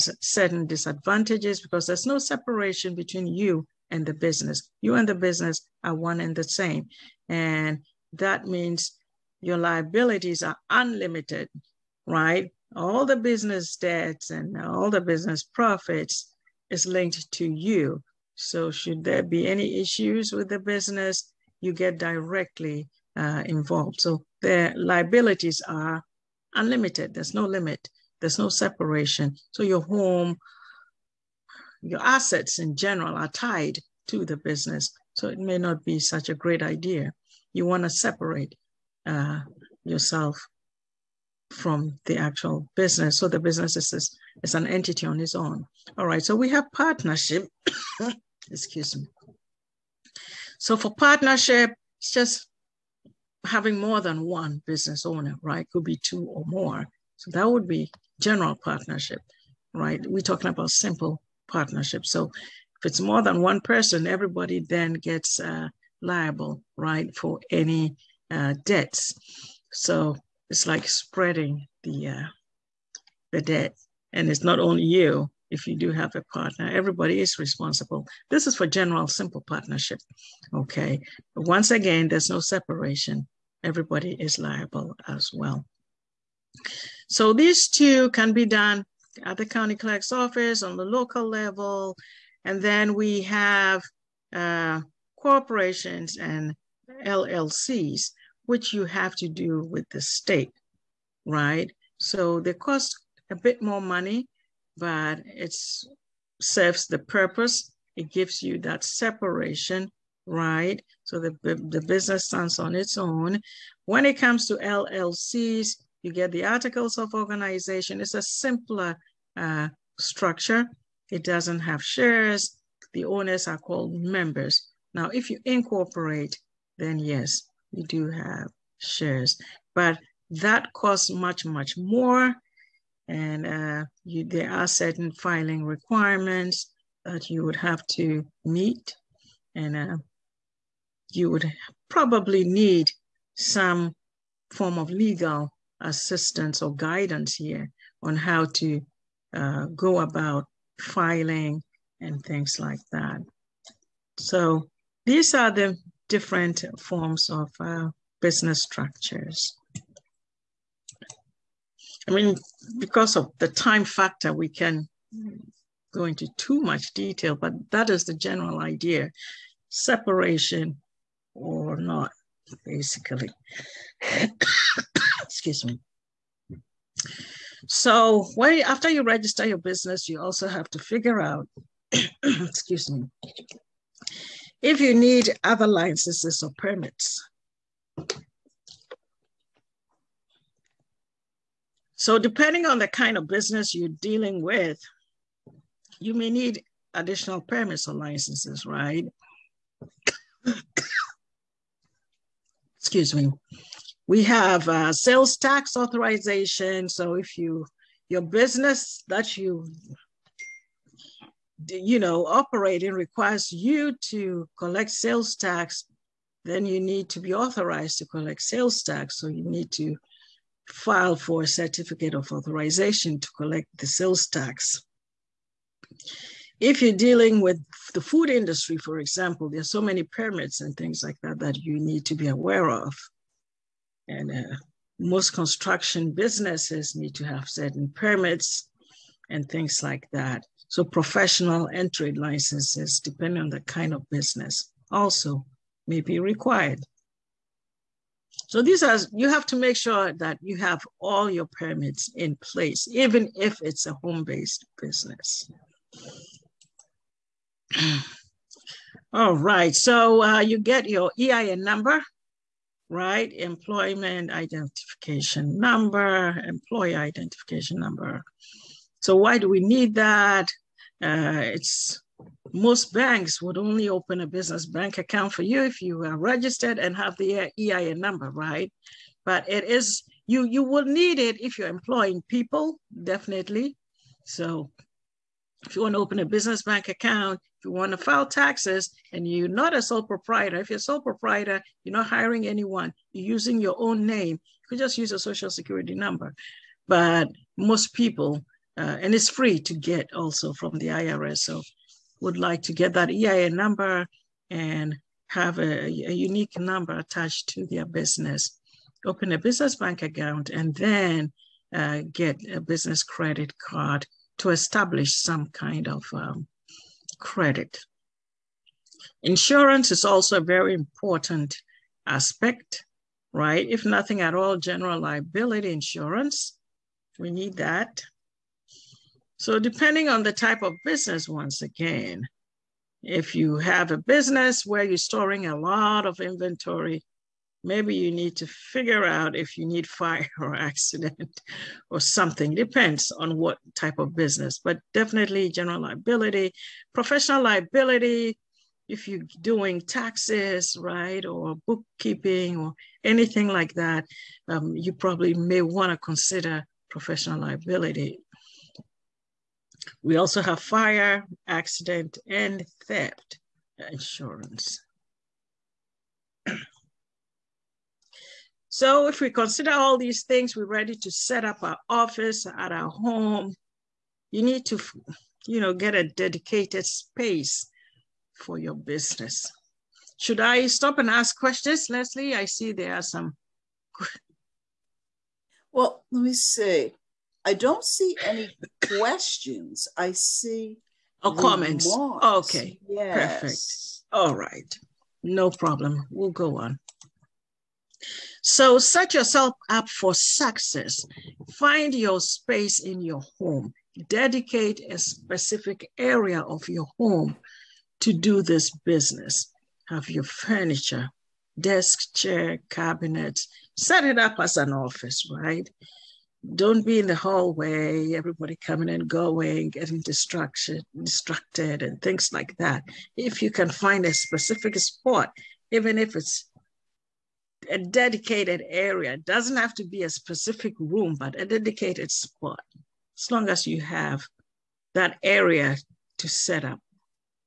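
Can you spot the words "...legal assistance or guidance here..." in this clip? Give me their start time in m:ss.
2:24.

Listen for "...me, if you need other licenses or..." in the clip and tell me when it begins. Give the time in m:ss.
3:02.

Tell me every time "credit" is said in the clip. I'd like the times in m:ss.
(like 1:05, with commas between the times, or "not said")
5:13, 5:17.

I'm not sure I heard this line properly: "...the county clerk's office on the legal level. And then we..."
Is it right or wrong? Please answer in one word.
wrong.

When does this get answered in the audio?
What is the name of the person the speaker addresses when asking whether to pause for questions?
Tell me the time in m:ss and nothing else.
6:21.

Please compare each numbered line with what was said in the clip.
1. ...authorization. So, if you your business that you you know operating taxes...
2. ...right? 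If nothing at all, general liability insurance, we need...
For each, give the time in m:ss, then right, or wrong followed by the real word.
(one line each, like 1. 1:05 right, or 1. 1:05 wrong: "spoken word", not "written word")
1. 3:25 wrong: "requires", not "taxes"
2. 5:23 right.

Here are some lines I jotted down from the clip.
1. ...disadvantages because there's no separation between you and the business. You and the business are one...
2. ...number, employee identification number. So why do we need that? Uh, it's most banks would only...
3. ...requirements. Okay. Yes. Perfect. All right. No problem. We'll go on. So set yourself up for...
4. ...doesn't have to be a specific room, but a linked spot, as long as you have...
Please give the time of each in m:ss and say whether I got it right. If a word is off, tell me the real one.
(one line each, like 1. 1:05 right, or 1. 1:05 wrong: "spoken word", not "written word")
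1. 0:00 right
2. 4:25 right
3. 6:31 wrong: "comments", not "requirements"
4. 7:09 wrong: "dedicated", not "linked".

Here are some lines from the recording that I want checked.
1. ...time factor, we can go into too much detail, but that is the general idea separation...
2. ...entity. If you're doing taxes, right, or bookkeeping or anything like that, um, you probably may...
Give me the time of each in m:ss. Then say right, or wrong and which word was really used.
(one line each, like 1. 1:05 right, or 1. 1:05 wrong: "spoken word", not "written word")
1. 2:43 right
2. 5:47 wrong: "liability", not "entity".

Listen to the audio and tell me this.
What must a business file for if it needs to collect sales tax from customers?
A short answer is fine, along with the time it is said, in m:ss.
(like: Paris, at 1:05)
Certificate of authorization, at 3:41.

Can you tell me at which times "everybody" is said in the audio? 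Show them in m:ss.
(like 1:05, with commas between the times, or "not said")
1:04, 1:16, 1:23, 6:58.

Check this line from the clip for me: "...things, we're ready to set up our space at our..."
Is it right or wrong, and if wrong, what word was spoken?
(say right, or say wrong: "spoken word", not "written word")
wrong: "office", not "space".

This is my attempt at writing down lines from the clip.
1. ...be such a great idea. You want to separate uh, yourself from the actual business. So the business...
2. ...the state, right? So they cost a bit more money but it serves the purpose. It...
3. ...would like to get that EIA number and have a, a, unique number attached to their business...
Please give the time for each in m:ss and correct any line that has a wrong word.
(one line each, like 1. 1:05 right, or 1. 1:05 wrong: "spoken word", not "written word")
1. 0:35 right
2. 1:39 right
3. 5:02 right.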